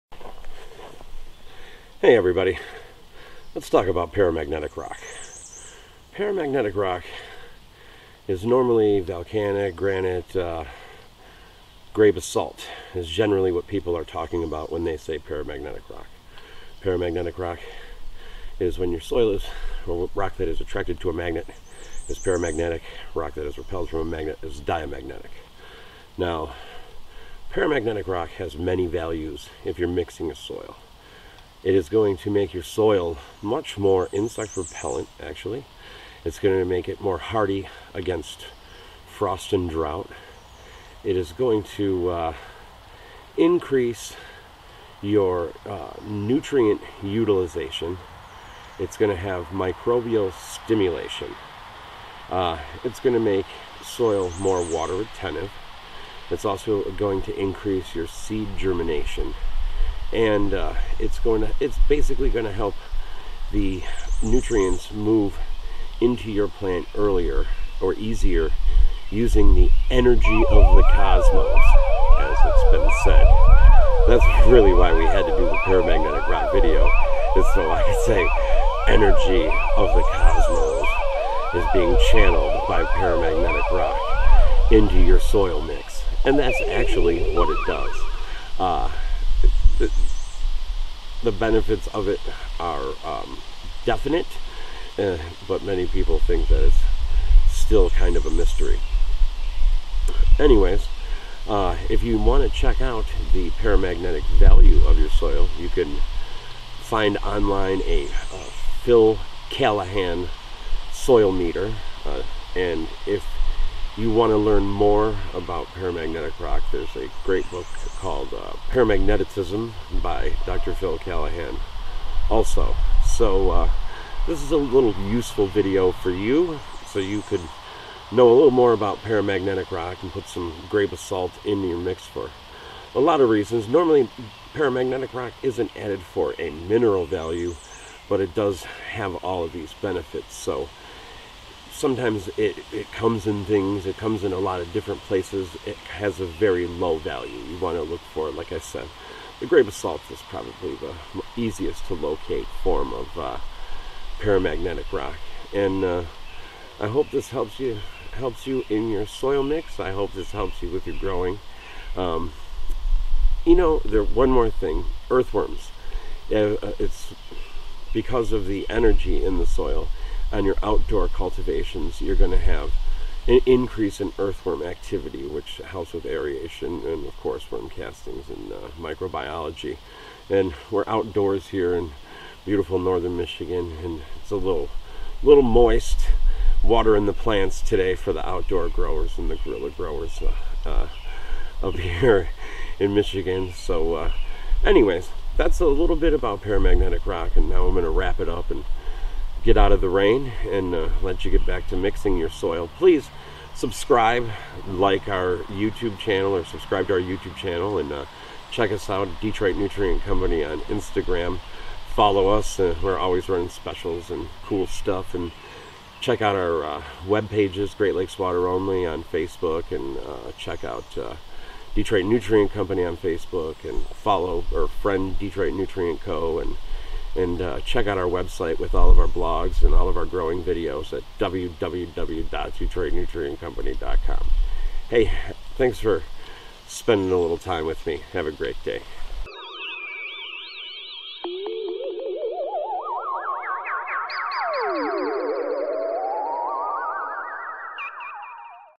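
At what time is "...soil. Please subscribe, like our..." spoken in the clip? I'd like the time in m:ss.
3:22.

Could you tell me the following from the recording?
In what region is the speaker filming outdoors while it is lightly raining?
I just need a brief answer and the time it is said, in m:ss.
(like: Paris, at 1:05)
Northern Michigan, at 3:02.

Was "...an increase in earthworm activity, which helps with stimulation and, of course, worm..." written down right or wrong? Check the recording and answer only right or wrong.
wrong.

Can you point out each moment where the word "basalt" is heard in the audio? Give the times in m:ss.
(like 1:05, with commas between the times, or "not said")
0:12, 2:10, 2:29.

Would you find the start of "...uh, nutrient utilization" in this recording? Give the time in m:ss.
0:45.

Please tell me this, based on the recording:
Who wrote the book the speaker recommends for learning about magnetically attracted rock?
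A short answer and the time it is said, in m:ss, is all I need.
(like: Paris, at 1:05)
Dr. Phil Callahan, at 2:00.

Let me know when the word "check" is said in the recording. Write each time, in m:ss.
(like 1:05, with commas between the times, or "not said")
1:42, 3:28, 3:35, 3:40, 3:47.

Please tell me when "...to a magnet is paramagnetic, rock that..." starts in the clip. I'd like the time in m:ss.
0:21.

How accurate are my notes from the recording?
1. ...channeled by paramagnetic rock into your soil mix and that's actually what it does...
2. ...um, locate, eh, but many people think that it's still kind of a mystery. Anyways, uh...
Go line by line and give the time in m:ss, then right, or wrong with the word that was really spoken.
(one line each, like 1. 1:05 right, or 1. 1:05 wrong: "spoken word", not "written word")
1. 1:22 right
2. 1:33 wrong: "definite", not "locate".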